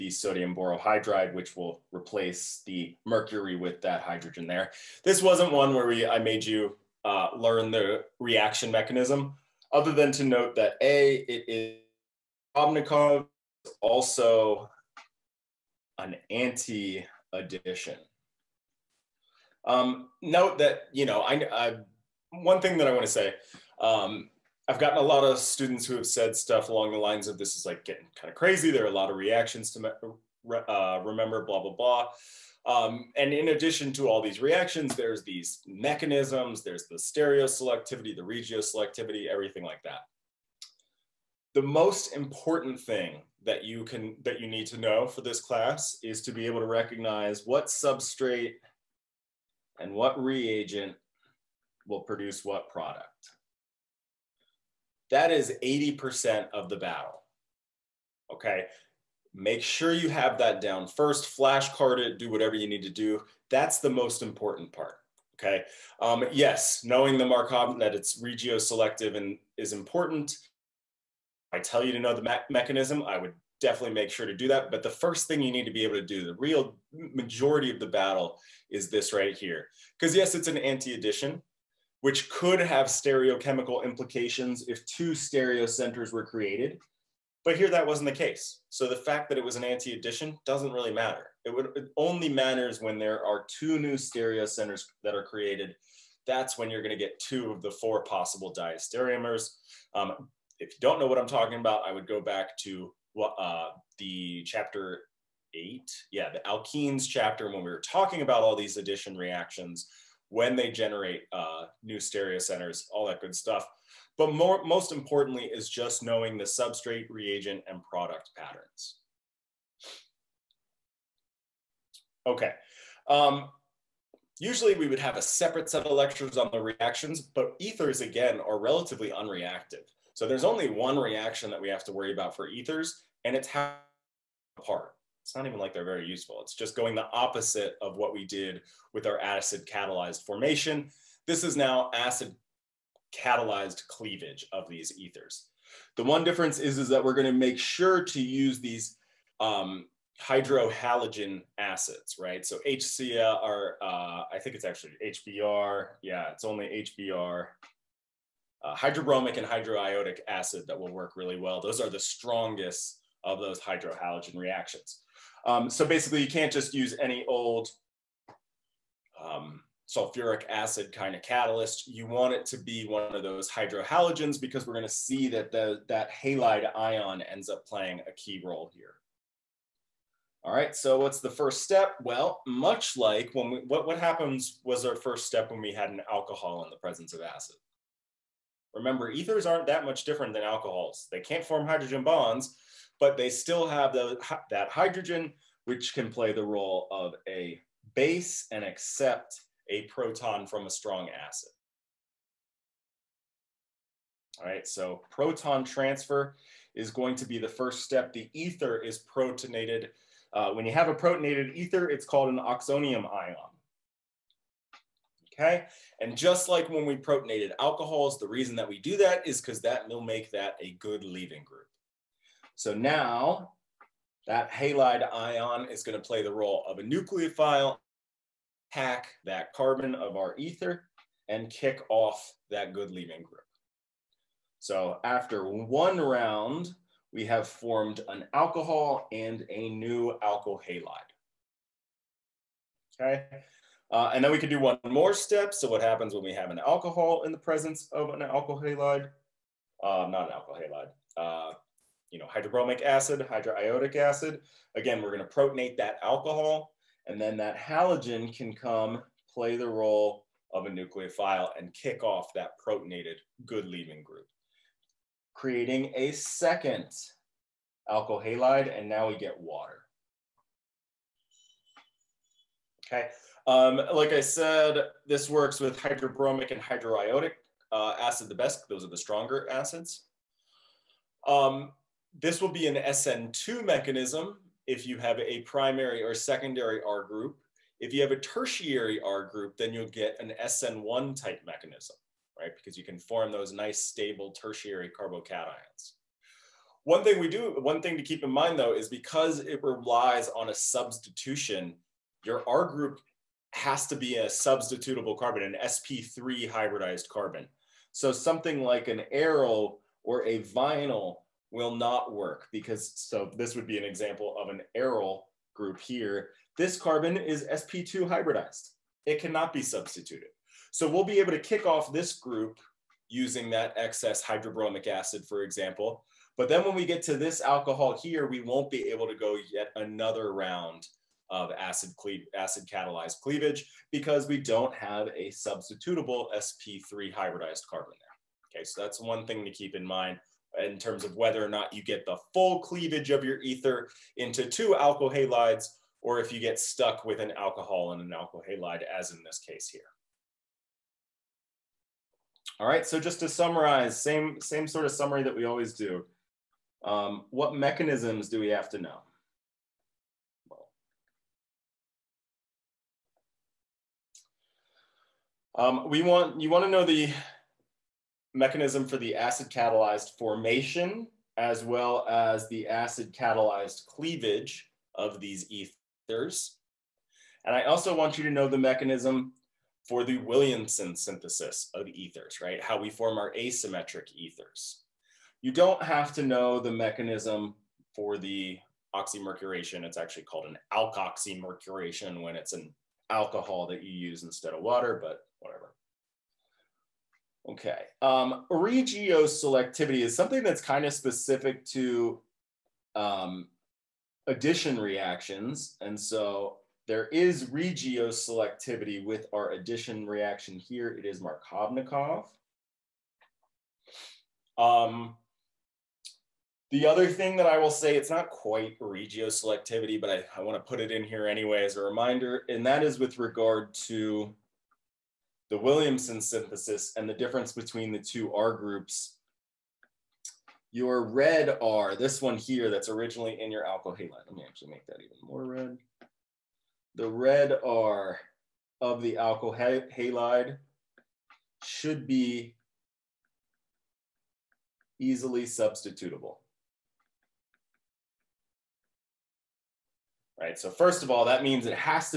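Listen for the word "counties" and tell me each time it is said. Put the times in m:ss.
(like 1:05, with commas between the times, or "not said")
not said.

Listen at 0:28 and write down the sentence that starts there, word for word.
There are a lot of reactions to uh, remember, blah, blah, blah.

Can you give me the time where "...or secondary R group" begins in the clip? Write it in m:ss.
4:46.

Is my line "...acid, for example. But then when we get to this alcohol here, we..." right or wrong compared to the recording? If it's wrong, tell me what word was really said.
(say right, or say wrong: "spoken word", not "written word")
right.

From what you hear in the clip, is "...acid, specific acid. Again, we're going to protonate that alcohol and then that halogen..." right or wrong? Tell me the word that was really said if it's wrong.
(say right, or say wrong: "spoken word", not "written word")
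wrong: "hydroiodic", not "specific".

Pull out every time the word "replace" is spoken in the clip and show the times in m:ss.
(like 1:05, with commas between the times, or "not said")
0:01.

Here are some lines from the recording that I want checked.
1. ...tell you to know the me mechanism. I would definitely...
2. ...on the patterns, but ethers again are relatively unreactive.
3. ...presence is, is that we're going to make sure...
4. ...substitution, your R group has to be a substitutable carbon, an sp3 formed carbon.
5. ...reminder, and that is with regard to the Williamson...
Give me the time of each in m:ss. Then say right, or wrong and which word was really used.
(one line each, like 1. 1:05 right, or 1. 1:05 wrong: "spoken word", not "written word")
1. 1:11 right
2. 2:06 wrong: "reactions", not "patterns"
3. 2:26 wrong: "difference", not "presence"
4. 5:00 wrong: "hybridized", not "formed"
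5. 7:01 right.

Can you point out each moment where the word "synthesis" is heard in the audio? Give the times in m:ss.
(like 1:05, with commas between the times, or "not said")
6:20, 7:06.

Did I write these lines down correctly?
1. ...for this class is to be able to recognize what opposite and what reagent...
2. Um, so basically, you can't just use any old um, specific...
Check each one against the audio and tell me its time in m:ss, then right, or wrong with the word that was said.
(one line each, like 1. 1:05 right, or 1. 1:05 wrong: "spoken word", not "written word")
1. 0:45 wrong: "substrate", not "opposite"
2. 2:45 wrong: "sulfuric", not "specific".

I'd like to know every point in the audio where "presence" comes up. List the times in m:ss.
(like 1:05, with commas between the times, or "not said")
3:06, 4:07.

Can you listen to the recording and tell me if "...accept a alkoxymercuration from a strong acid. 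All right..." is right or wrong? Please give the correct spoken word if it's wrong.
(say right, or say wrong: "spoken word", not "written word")
wrong: "proton", not "alkoxymercuration".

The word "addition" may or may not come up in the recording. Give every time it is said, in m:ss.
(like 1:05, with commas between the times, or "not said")
0:17, 0:33, 1:20, 1:29, 1:48, 6:44, 6:49.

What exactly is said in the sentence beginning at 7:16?
The red R of the alkyl halide should be easily substitutable.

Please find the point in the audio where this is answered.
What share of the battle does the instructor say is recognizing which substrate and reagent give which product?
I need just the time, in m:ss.
0:55.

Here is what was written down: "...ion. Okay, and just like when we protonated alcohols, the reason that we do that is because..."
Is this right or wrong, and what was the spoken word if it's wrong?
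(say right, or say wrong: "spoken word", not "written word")
right.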